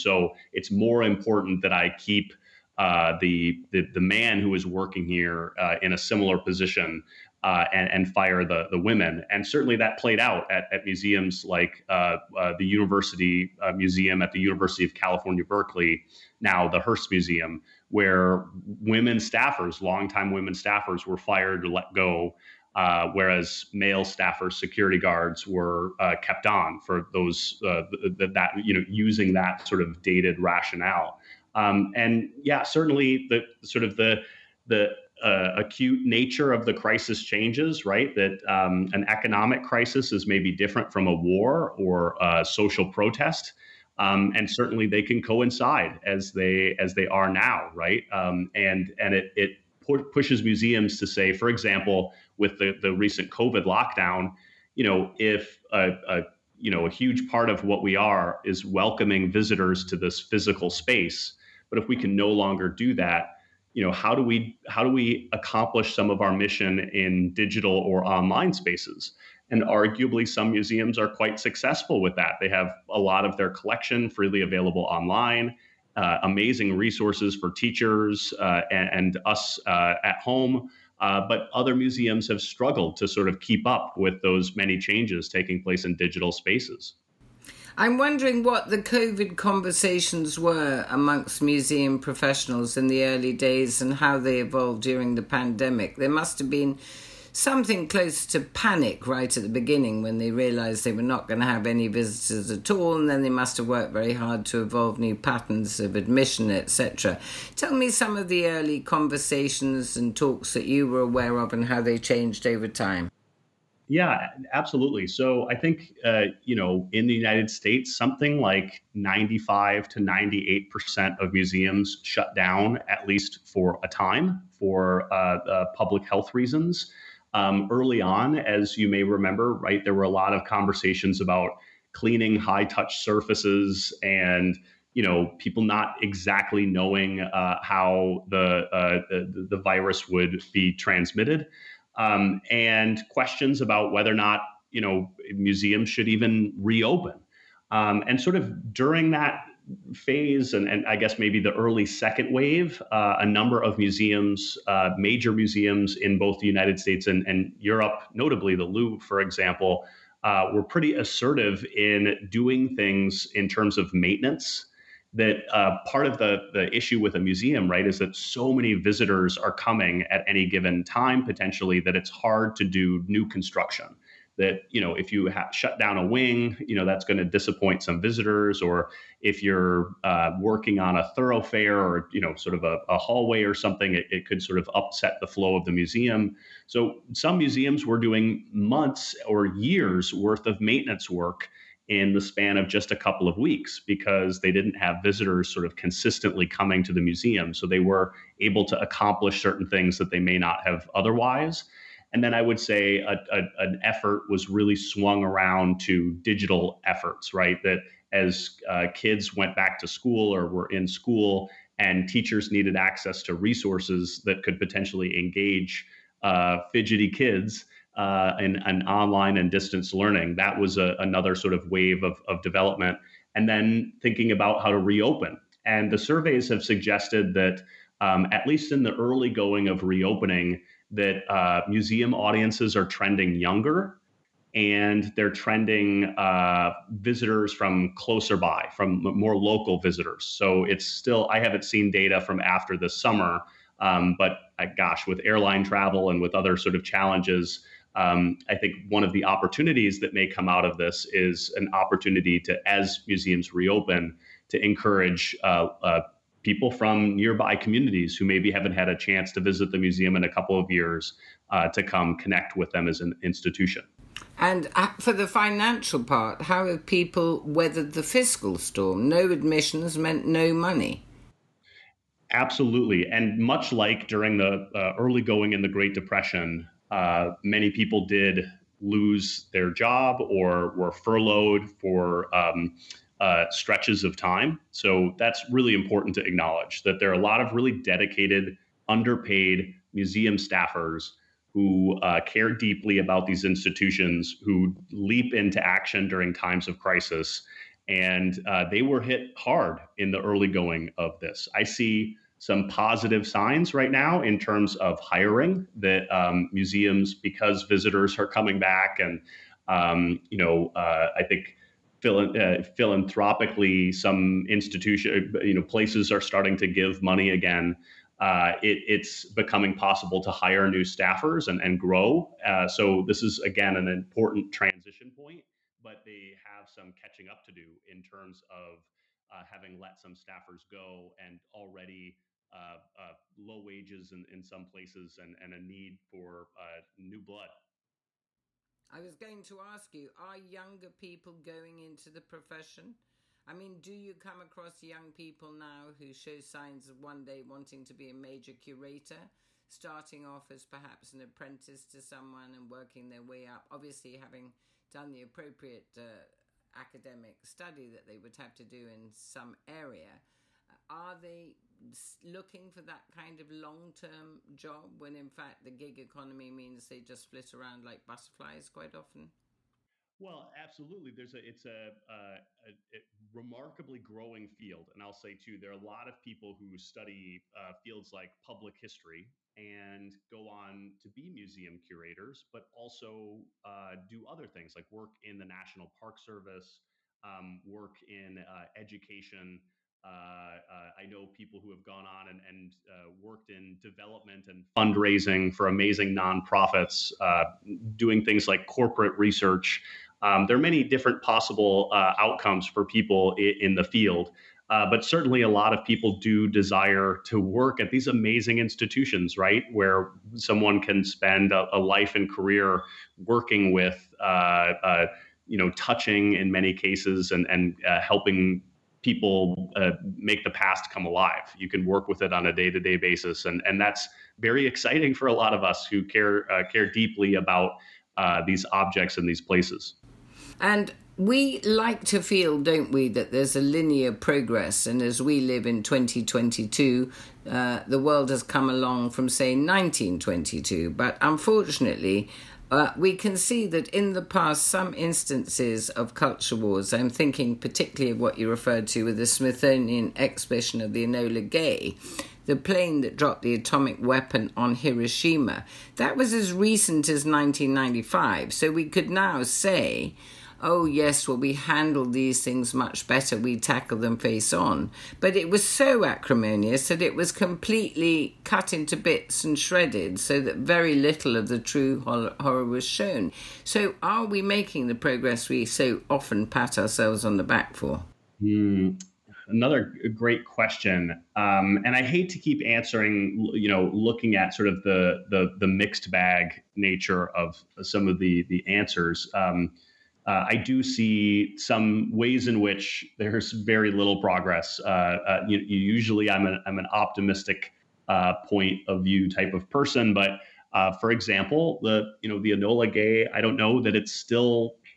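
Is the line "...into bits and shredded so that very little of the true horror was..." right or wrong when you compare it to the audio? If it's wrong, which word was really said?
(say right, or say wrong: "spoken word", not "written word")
right.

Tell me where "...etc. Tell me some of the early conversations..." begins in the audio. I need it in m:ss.
1:46.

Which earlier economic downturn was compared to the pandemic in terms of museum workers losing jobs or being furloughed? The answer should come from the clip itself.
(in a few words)
Great Depression.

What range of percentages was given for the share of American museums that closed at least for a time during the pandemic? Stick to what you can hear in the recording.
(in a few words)
95 to 98%.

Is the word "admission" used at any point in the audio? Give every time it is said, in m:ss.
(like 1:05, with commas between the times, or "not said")
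1:45, 4:29.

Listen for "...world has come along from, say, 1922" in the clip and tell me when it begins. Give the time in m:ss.
7:17.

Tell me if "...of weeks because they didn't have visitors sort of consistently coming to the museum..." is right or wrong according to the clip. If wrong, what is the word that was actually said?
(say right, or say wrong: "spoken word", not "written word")
right.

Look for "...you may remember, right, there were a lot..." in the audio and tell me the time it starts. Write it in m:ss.
2:08.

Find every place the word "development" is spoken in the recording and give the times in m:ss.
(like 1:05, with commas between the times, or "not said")
3:42, 6:33.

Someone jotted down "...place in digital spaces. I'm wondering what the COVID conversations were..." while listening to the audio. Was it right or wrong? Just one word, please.
right.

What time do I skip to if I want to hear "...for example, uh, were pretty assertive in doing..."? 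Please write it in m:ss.
2:39.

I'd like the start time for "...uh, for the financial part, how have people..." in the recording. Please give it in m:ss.
4:24.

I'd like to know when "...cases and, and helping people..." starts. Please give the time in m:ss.
6:56.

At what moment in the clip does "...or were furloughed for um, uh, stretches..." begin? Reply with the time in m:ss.
4:40.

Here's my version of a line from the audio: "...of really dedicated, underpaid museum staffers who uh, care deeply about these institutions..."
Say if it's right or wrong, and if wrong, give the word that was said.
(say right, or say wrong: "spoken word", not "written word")
right.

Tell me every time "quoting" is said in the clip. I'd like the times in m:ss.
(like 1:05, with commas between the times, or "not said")
not said.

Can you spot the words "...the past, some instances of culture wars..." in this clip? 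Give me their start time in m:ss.
7:24.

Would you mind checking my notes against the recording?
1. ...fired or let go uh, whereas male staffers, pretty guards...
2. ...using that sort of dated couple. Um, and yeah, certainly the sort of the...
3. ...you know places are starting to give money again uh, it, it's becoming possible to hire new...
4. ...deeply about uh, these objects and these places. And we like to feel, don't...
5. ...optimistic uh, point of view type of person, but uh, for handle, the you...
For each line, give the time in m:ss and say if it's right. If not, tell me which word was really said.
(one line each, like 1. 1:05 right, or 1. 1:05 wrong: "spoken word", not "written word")
1. 0:21 wrong: "security", not "pretty"
2. 0:28 wrong: "rationale", not "couple"
3. 5:15 right
4. 7:06 right
5. 8:16 wrong: "example", not "handle".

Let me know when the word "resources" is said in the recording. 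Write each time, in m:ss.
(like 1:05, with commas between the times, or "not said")
1:16, 3:33.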